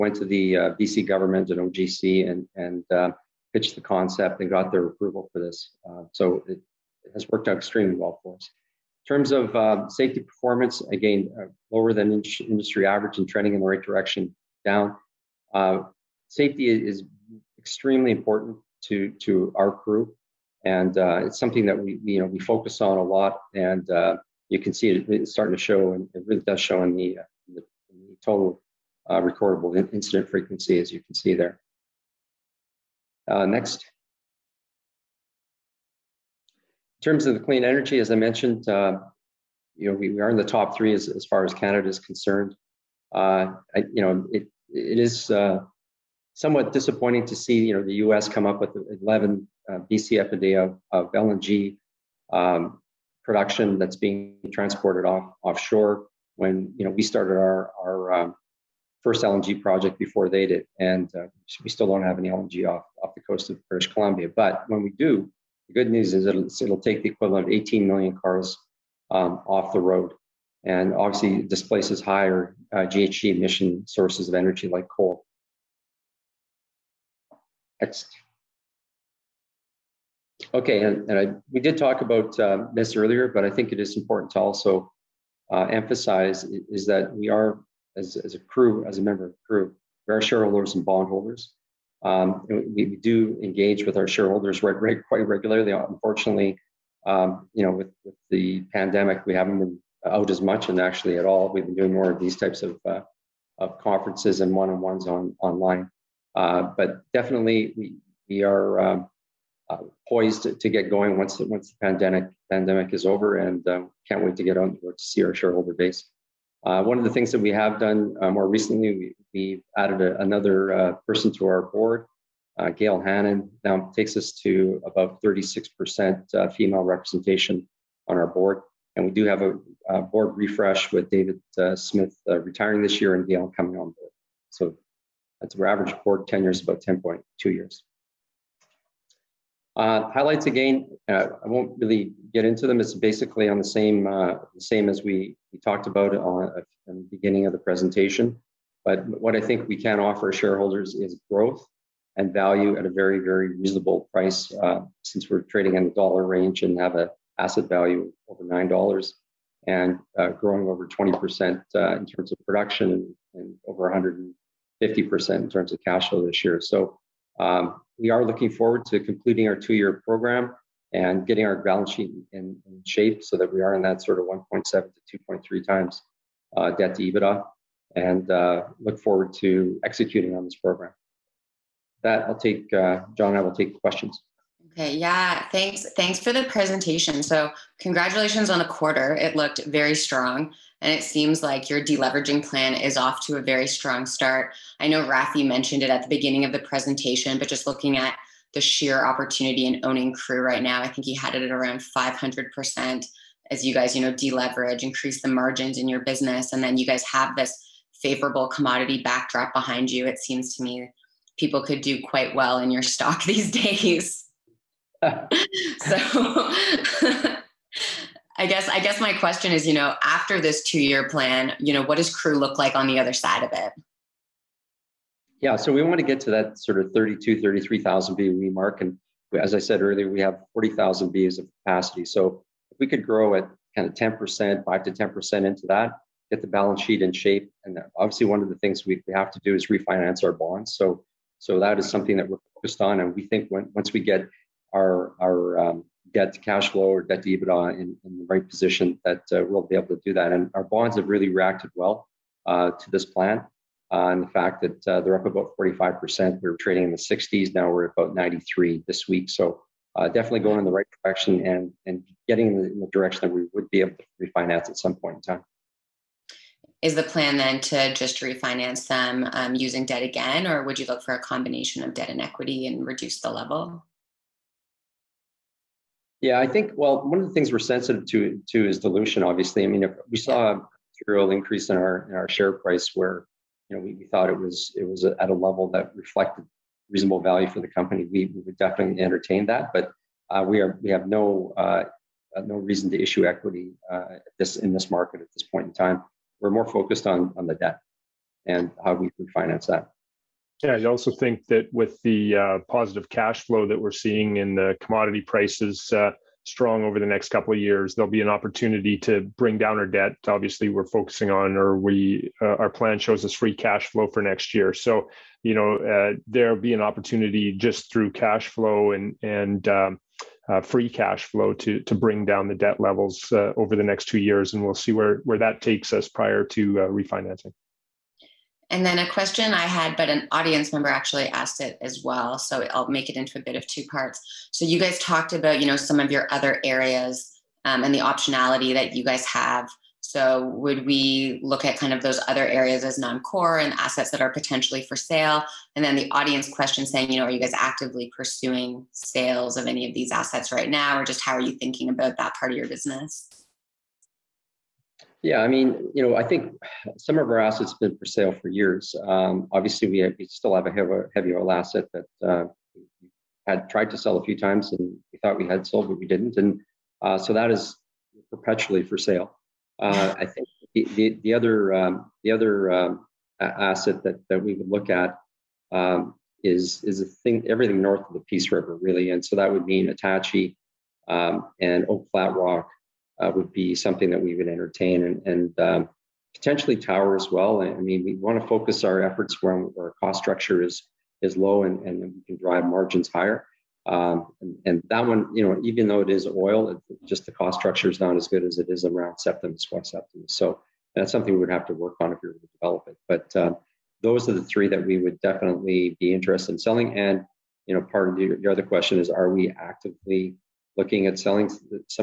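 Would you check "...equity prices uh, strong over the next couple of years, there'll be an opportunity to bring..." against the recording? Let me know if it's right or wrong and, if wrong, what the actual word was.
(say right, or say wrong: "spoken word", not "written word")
wrong: "commodity", not "equity".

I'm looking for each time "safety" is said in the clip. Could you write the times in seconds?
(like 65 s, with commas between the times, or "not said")
9 s, 16 s.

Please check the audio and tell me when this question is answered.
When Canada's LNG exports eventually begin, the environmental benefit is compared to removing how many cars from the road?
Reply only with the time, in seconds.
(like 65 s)
67 s.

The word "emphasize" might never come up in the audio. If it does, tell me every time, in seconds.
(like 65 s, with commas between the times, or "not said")
85 s.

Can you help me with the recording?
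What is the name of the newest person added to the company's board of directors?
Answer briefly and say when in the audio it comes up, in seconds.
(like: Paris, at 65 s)
Gail Hannon, at 122 s.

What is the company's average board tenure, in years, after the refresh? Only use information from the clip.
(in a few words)
10.2 years.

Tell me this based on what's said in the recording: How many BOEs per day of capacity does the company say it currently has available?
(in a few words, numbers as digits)
40,000.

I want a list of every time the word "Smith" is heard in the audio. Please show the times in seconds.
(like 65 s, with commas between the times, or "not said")
131 s.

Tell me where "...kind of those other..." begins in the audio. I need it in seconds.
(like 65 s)
341 s.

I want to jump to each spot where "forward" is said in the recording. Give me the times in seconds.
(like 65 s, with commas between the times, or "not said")
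168 s, 178 s.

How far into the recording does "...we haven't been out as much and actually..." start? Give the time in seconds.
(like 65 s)
99 s.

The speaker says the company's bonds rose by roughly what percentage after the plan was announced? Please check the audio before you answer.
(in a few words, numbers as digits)
45%.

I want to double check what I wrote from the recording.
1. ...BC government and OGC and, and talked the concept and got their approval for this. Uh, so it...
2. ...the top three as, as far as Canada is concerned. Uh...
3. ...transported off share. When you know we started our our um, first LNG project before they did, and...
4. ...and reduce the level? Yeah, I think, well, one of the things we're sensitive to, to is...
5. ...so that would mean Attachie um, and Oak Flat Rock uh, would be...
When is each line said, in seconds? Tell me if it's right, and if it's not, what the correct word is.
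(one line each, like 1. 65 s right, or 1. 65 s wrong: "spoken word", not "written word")
1. 0 s wrong: "pitched", not "talked"
2. 40 s right
3. 54 s wrong: "offshore", not "share"
4. 272 s right
5. 379 s right.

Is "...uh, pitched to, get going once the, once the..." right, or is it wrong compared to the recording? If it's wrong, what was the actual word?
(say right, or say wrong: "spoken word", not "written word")
wrong: "poised", not "pitched".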